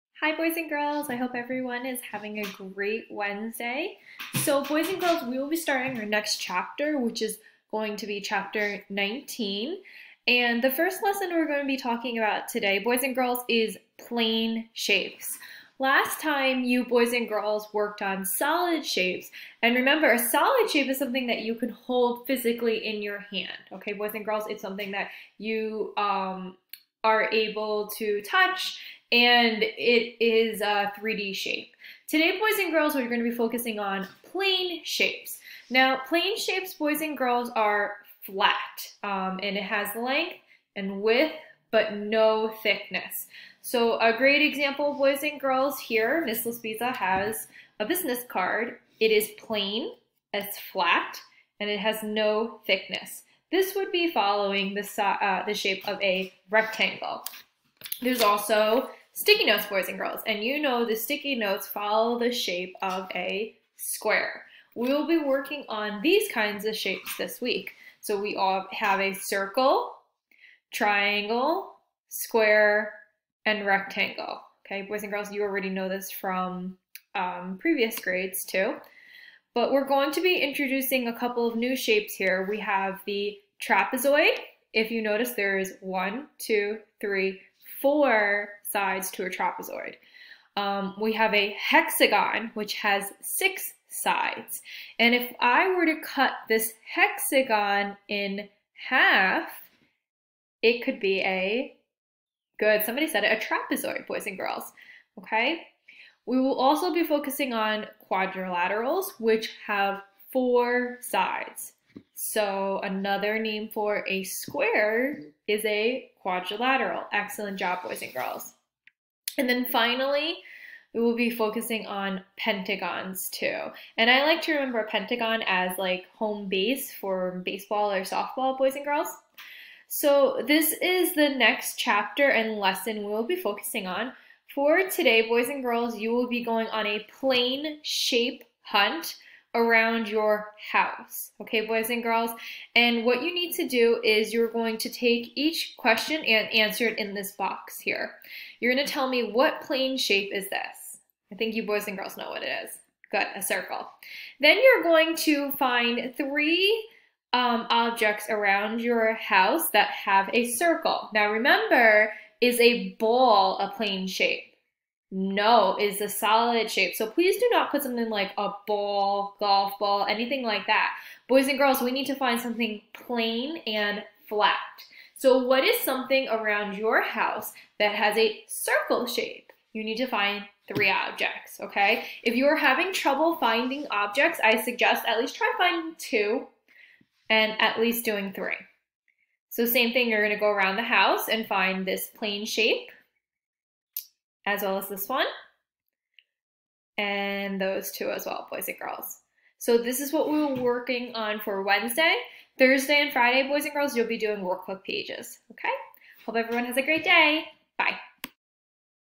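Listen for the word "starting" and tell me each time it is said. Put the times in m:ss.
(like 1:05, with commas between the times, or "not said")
0:05.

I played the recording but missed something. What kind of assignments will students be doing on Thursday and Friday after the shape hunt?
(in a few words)
workbook pages.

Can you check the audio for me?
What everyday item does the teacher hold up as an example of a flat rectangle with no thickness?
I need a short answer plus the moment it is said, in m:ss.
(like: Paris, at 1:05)
business card, at 0:47.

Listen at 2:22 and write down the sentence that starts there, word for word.
And what you need to do is you're going to take each question and answer it in this box here.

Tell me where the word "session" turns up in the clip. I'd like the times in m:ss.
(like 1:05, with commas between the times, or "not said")
not said.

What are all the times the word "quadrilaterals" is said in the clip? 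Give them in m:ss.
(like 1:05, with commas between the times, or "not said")
1:48, 1:56.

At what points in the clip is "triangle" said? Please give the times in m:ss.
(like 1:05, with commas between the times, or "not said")
1:10.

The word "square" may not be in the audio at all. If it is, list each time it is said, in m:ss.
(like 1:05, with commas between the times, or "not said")
1:03, 1:12, 1:54.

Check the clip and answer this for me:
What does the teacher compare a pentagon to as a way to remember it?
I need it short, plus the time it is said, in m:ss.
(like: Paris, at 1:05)
home base, at 2:06.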